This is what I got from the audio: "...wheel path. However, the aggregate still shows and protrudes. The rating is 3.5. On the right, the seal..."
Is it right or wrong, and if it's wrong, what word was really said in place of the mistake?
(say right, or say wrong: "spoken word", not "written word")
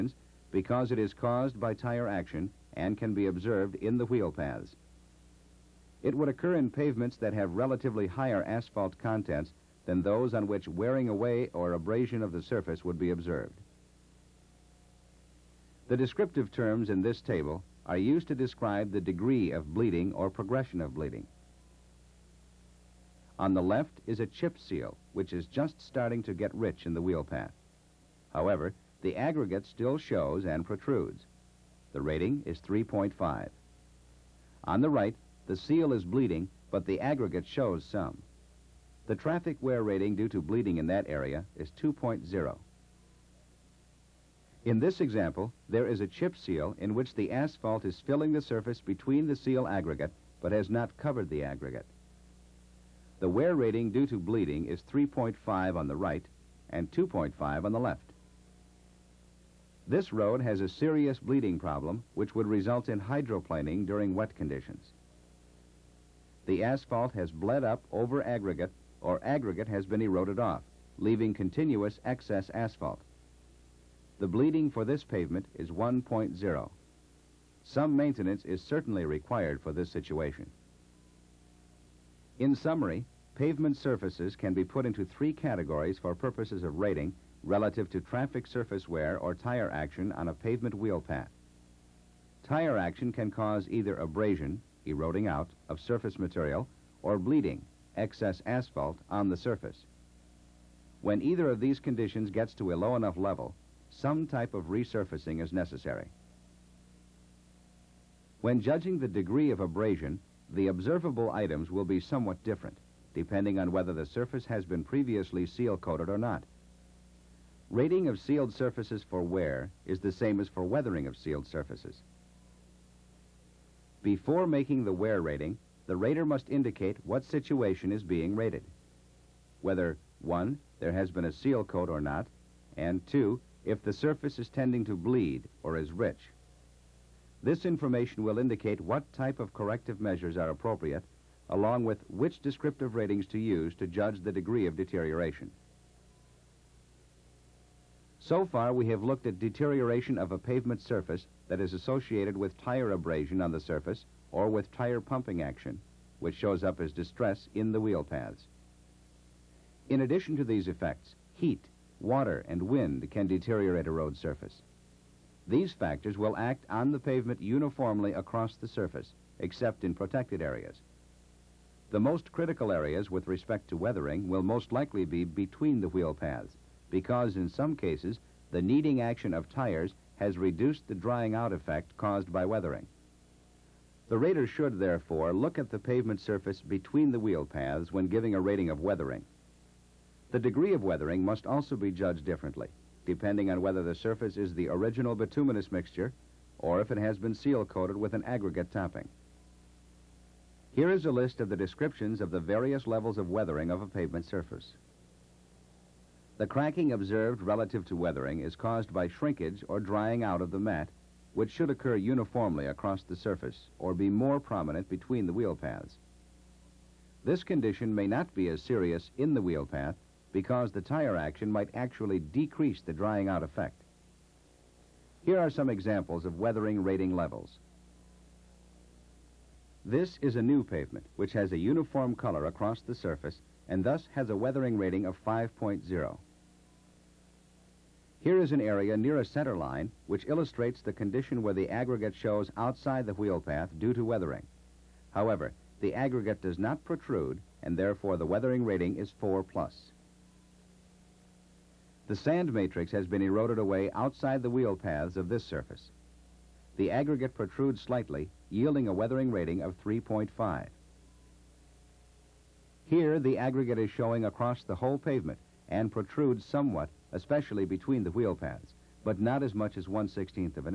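right.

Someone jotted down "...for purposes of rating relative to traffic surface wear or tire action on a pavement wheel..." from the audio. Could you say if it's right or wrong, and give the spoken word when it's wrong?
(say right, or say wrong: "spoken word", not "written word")
right.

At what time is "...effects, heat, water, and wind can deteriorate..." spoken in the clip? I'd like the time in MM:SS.
02:40.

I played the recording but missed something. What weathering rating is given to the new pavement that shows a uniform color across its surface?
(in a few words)
5.0.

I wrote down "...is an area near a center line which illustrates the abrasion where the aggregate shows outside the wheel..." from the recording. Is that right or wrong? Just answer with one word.
wrong.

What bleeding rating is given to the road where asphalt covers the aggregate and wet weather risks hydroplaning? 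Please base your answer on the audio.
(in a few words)
1.0.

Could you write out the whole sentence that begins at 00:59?
This road has a serious bleeding problem which would result in hydroplaning during wet conditions.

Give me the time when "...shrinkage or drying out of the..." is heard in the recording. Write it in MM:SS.
03:29.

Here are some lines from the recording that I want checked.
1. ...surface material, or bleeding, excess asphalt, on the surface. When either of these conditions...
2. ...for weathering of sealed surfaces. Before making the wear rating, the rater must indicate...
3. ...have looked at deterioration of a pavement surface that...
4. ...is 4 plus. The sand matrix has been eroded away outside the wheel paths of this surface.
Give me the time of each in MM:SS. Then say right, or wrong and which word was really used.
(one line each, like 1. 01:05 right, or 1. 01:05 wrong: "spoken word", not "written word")
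1. 01:35 right
2. 02:00 right
3. 02:28 right
4. 04:08 right.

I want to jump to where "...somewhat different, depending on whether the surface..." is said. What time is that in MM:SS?
01:52.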